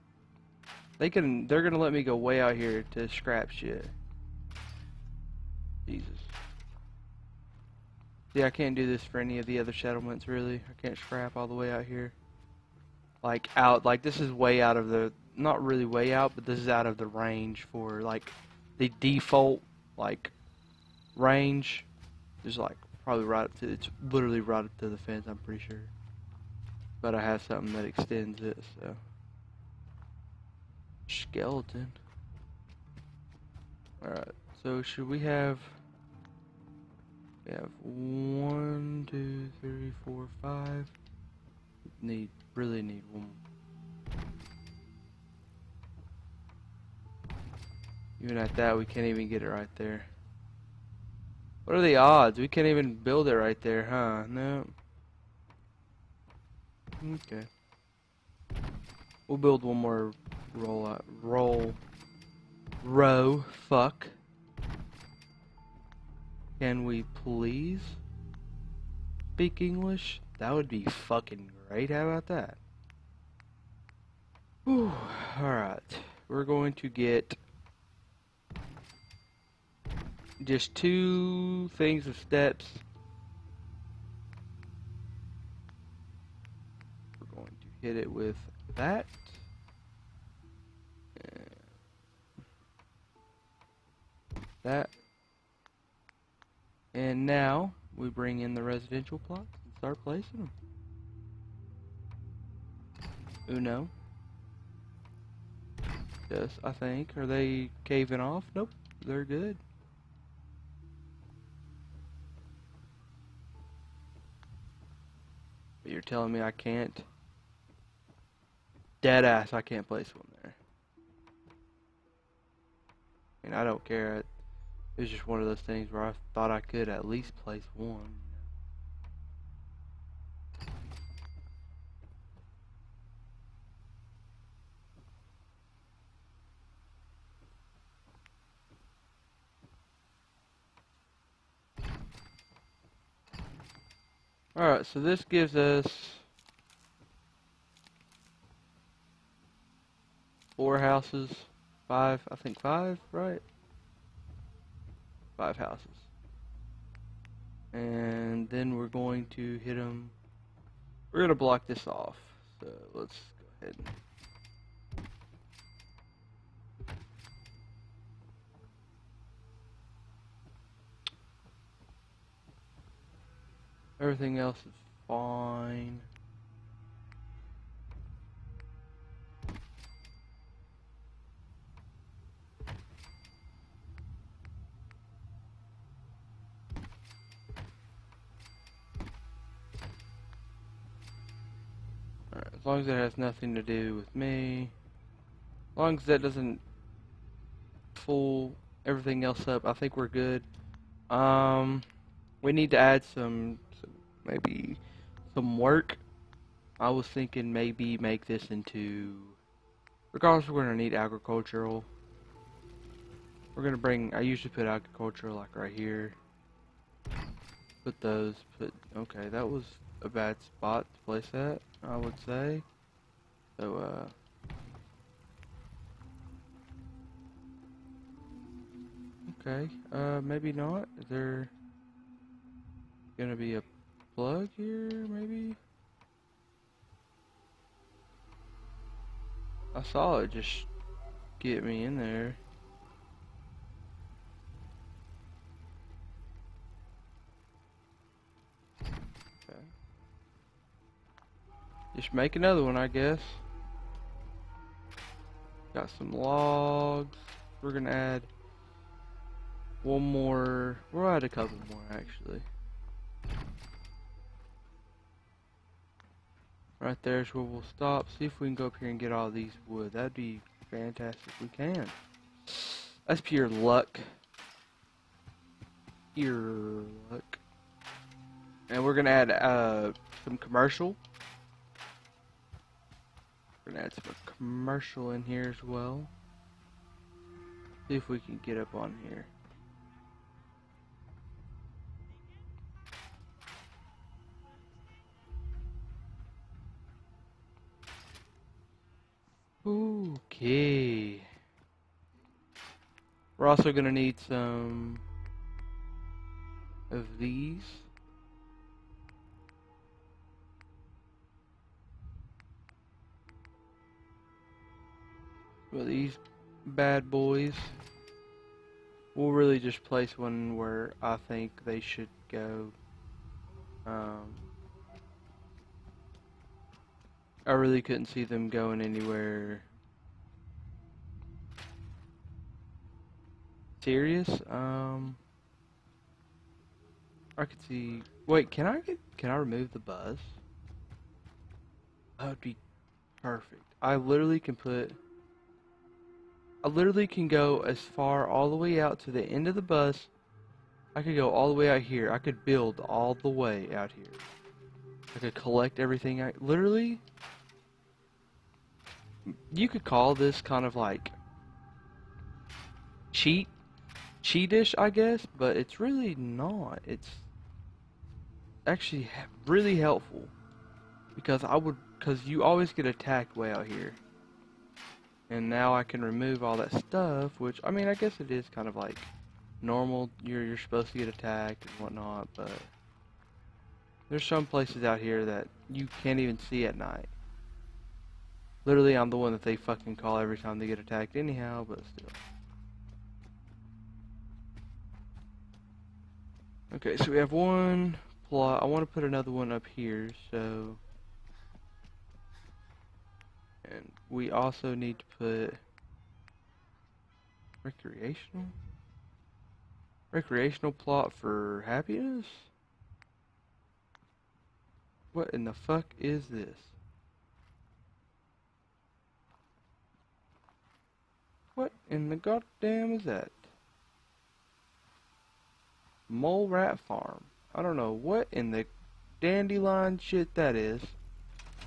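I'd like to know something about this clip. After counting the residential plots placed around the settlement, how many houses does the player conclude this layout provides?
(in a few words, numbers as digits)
5.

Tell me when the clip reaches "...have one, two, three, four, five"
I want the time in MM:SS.
00:37.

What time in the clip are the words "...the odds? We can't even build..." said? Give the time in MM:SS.
00:51.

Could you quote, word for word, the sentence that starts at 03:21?
Um, we need to add some maybe some work.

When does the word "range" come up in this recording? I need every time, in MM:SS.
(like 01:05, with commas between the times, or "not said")
00:17, 00:21.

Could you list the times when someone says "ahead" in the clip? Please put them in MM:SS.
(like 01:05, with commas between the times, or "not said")
02:43.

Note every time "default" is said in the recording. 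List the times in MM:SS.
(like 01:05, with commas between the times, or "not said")
00:18.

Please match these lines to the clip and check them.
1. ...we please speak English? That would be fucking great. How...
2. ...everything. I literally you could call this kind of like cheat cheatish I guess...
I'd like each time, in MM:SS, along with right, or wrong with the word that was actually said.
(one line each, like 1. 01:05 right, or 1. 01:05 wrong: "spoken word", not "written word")
1. 01:06 right
2. 05:55 right.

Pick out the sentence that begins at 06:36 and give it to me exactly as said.
Okay, so we have one plot.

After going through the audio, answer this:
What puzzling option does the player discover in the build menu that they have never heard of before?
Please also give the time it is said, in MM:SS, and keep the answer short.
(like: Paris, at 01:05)
Mole Rat Farm, at 07:06.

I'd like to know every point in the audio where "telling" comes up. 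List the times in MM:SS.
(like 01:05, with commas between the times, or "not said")
01:56.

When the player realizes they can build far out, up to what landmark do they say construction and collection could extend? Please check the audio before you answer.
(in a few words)
The bus.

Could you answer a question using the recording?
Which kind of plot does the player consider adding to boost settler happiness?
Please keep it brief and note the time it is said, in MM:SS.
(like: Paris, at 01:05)
Recreational, at 06:50.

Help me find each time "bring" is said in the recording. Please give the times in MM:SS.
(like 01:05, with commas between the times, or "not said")
01:38, 03:33.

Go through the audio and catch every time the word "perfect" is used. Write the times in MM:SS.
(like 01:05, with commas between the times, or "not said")
05:43.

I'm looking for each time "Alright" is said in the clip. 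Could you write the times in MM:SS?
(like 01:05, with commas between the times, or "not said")
01:14, 02:24.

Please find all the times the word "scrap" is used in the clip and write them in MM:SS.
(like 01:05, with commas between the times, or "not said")
00:03, 00:10.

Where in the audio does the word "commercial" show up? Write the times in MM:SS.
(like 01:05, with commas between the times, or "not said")
04:40, 04:44.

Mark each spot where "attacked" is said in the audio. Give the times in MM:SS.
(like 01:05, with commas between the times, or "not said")
06:12, 06:21, 06:30.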